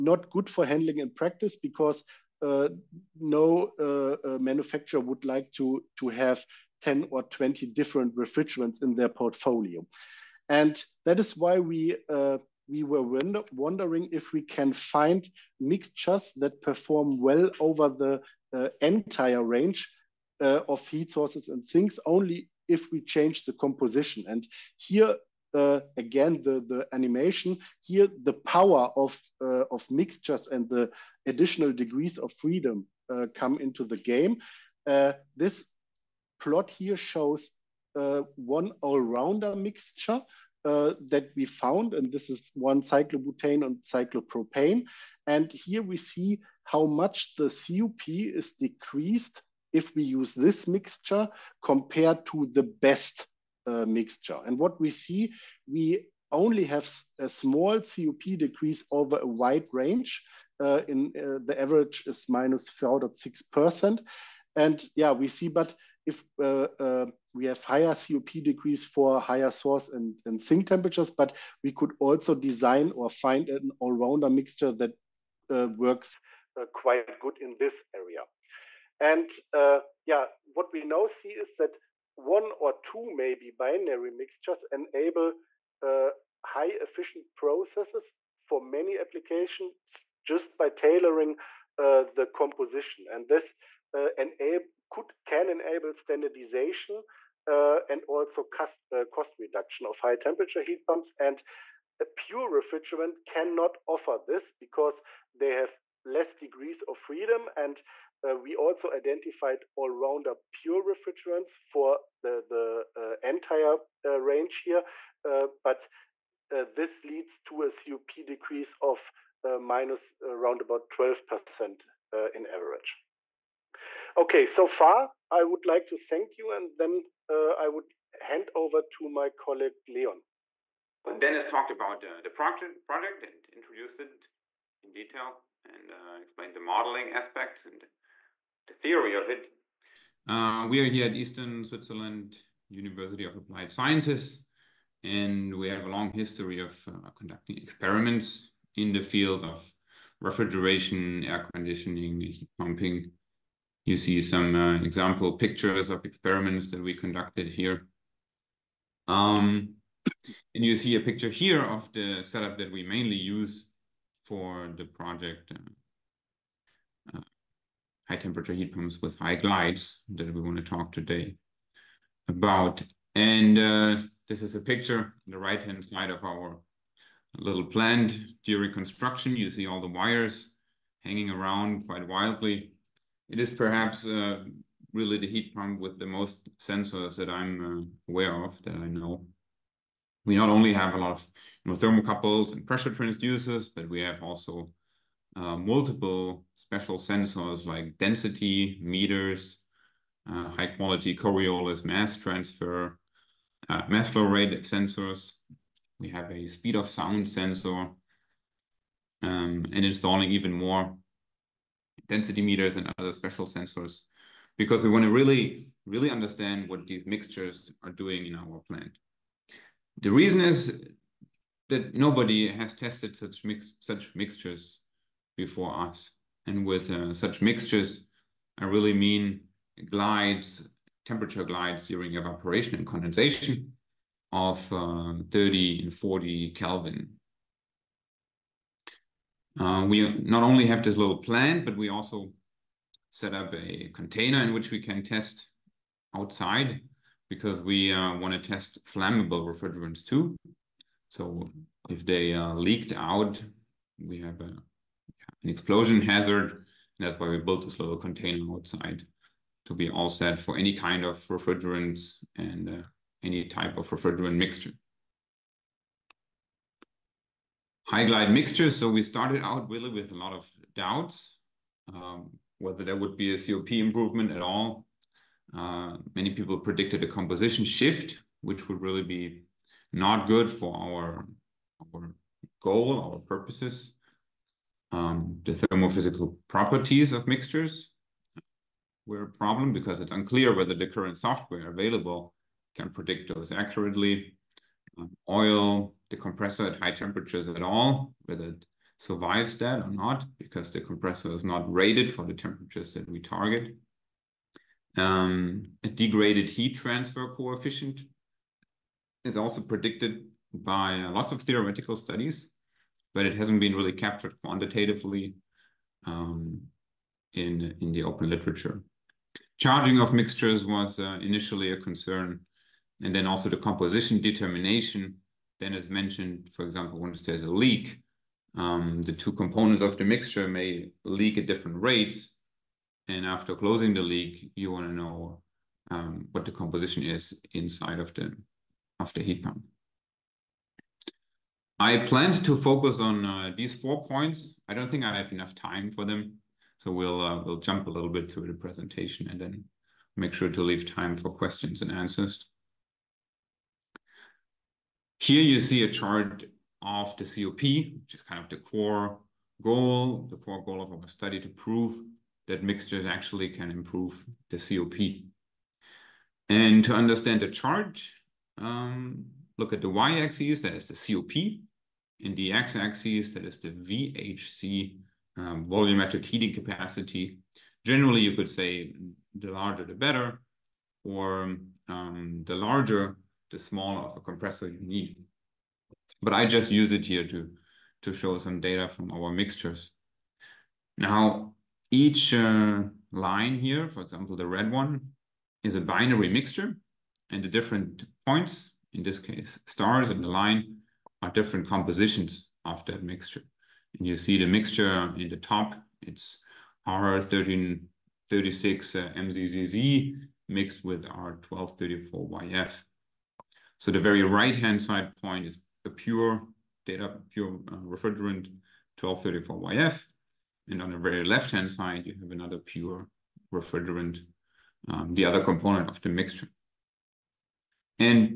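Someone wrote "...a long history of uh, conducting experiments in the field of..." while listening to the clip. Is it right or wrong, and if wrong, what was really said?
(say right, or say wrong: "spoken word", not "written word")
right.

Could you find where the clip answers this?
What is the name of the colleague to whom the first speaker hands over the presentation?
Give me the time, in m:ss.
2:09.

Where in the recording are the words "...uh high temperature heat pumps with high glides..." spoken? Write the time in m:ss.
2:47.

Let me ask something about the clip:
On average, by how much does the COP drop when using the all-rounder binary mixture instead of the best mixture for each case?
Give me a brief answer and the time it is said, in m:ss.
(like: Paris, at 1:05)
-4.6%, at 1:02.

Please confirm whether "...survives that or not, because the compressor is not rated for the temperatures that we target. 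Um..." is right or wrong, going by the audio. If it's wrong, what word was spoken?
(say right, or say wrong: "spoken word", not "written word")
right.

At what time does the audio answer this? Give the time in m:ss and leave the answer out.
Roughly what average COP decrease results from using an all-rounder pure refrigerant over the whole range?
2:00.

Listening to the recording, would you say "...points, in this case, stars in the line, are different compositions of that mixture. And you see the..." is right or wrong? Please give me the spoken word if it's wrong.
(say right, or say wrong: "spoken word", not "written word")
right.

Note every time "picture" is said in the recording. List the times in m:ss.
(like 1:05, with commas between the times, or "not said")
2:35, 2:40, 2:54.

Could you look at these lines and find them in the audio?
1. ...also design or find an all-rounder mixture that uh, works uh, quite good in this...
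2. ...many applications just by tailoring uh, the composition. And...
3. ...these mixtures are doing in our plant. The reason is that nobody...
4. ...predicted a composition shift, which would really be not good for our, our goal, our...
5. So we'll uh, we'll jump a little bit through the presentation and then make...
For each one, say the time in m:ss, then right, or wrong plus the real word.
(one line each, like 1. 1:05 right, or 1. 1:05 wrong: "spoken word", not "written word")
1. 1:11 right
2. 1:28 right
3. 3:36 right
4. 4:36 right
5. 5:46 right.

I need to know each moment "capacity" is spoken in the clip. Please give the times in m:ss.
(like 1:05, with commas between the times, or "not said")
6:16.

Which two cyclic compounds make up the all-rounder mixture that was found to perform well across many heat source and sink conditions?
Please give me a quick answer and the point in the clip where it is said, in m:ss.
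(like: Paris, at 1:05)
Cyclobutane and cyclopropane, at 0:42.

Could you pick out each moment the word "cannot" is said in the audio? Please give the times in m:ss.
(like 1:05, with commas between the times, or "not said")
1:43.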